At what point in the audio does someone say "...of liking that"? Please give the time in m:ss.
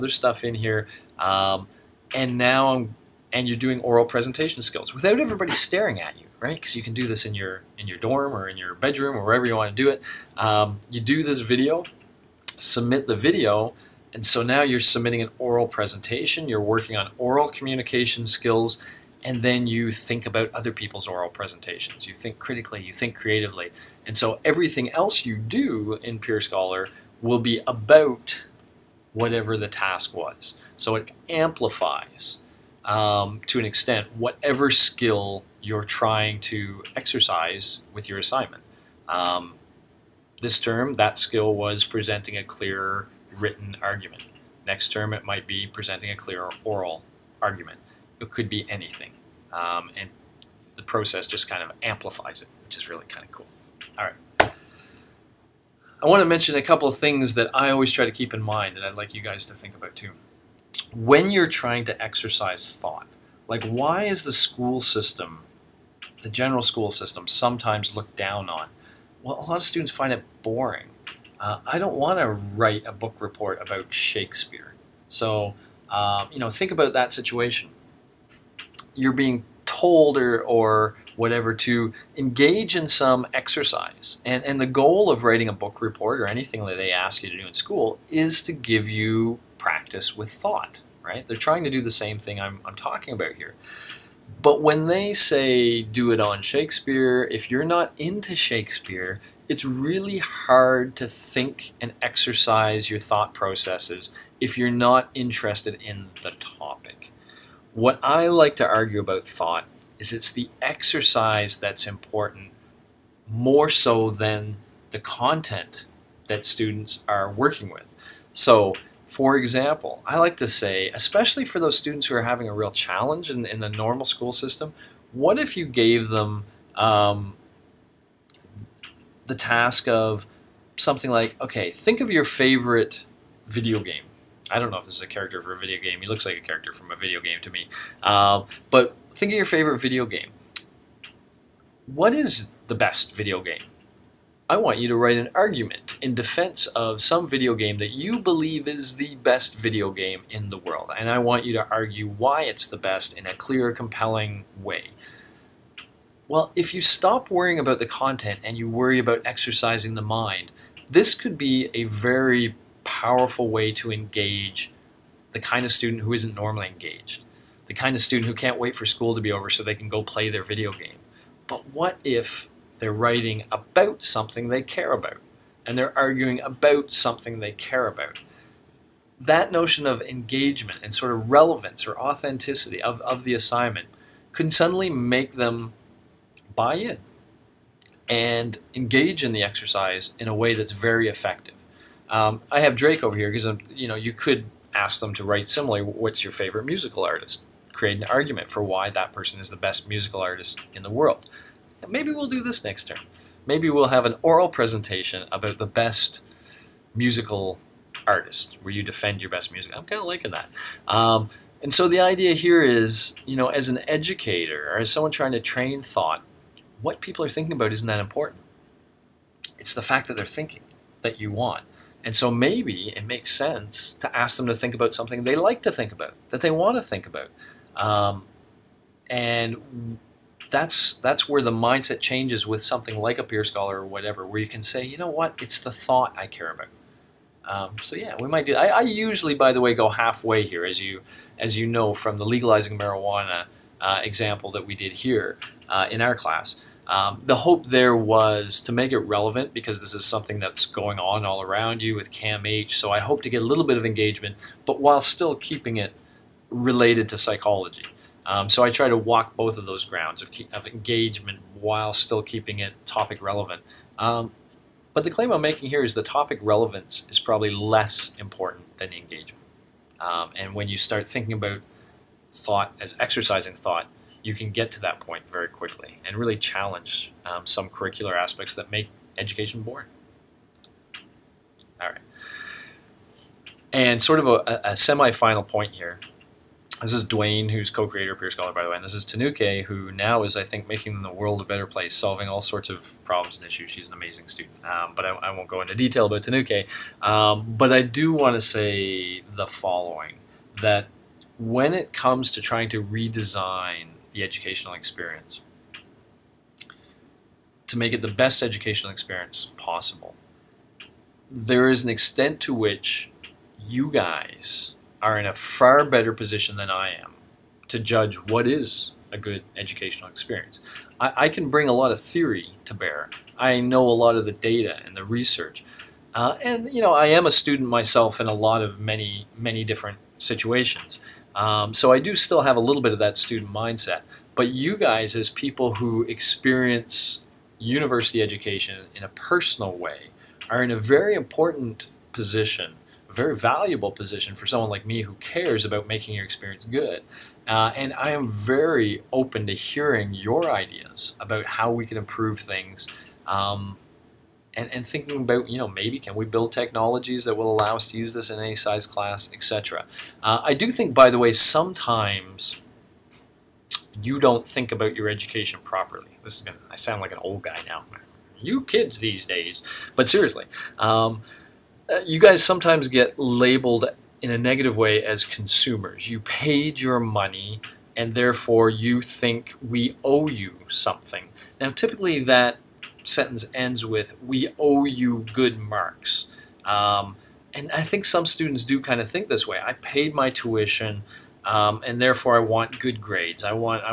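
3:30.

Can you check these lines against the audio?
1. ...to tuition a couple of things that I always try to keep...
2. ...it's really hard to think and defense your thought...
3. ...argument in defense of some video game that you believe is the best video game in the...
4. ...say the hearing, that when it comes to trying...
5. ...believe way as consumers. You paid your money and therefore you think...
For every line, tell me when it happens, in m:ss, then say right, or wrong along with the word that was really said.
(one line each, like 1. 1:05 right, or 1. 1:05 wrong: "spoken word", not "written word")
1. 0:56 wrong: "mention", not "tuition"
2. 1:39 wrong: "exercise", not "defense"
3. 2:25 right
4. 4:58 wrong: "following", not "hearing"
5. 6:14 wrong: "negative", not "believe".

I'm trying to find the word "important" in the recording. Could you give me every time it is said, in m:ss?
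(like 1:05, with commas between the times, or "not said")
1:51, 3:38, 4:28, 5:41.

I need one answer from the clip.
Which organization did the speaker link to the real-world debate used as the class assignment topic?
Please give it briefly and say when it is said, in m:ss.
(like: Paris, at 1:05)
CAMH, at 4:12.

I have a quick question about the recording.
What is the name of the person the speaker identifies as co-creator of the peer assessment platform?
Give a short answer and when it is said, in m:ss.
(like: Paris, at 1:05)
Dwayne, at 4:47.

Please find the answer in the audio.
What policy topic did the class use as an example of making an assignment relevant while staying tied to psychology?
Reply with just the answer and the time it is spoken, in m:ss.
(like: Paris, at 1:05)
legalizing marijuana, at 4:02.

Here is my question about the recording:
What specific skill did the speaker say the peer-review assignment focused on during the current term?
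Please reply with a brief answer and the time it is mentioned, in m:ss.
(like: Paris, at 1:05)
presenting a clear written argument, at 0:41.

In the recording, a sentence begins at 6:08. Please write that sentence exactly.
You kids these days, but seriously.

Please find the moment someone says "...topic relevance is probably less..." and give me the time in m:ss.
4:26.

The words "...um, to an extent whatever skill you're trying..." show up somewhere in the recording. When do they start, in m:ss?
0:32.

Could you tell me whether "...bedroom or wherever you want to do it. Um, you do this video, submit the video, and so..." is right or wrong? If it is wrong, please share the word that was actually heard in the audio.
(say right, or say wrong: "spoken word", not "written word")
right.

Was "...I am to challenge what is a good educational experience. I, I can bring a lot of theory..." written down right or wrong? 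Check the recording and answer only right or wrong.
wrong.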